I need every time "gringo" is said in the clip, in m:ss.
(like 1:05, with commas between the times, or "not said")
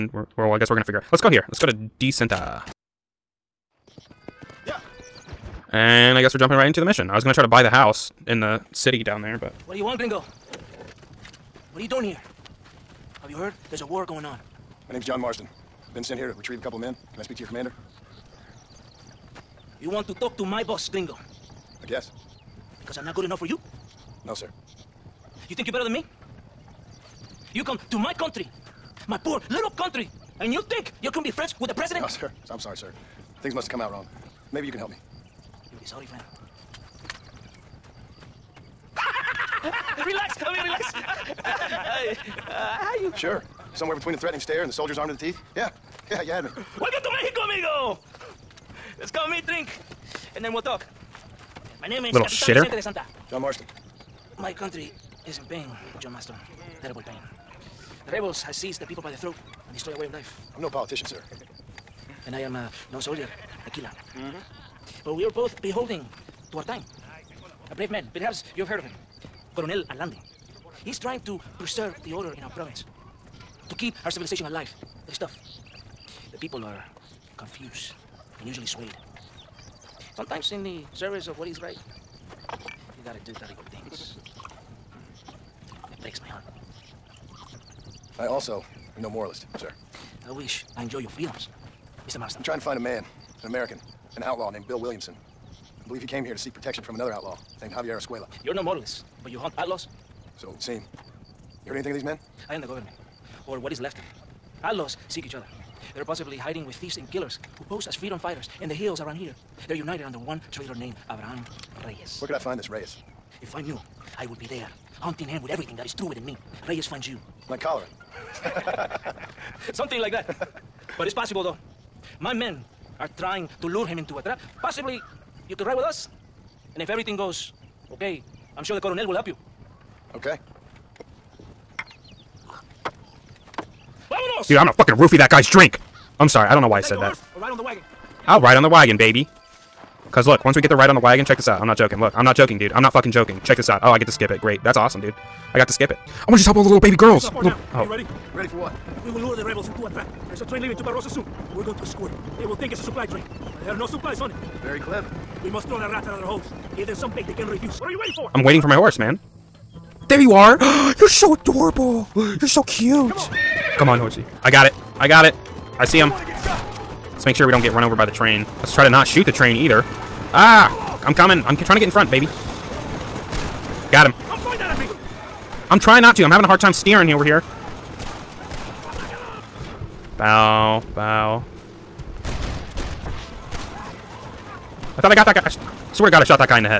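0:09, 0:20.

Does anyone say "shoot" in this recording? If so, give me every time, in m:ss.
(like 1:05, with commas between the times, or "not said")
2:49.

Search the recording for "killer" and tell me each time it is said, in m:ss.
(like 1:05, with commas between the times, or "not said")
1:03, 1:47.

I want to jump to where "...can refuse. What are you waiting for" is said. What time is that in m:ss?
2:37.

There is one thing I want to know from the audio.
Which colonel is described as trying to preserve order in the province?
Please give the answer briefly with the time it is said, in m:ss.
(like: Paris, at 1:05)
Coronel Allende, at 1:09.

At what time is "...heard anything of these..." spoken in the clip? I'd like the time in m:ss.
1:41.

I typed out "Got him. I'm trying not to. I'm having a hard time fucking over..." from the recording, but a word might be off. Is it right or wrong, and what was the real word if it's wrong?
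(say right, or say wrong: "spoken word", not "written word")
wrong: "steering", not "fucking".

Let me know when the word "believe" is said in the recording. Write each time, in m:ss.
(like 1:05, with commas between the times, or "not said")
1:35.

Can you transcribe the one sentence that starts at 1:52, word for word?
Where could I find this Reyes?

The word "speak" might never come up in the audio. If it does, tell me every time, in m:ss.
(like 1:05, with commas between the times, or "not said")
0:17.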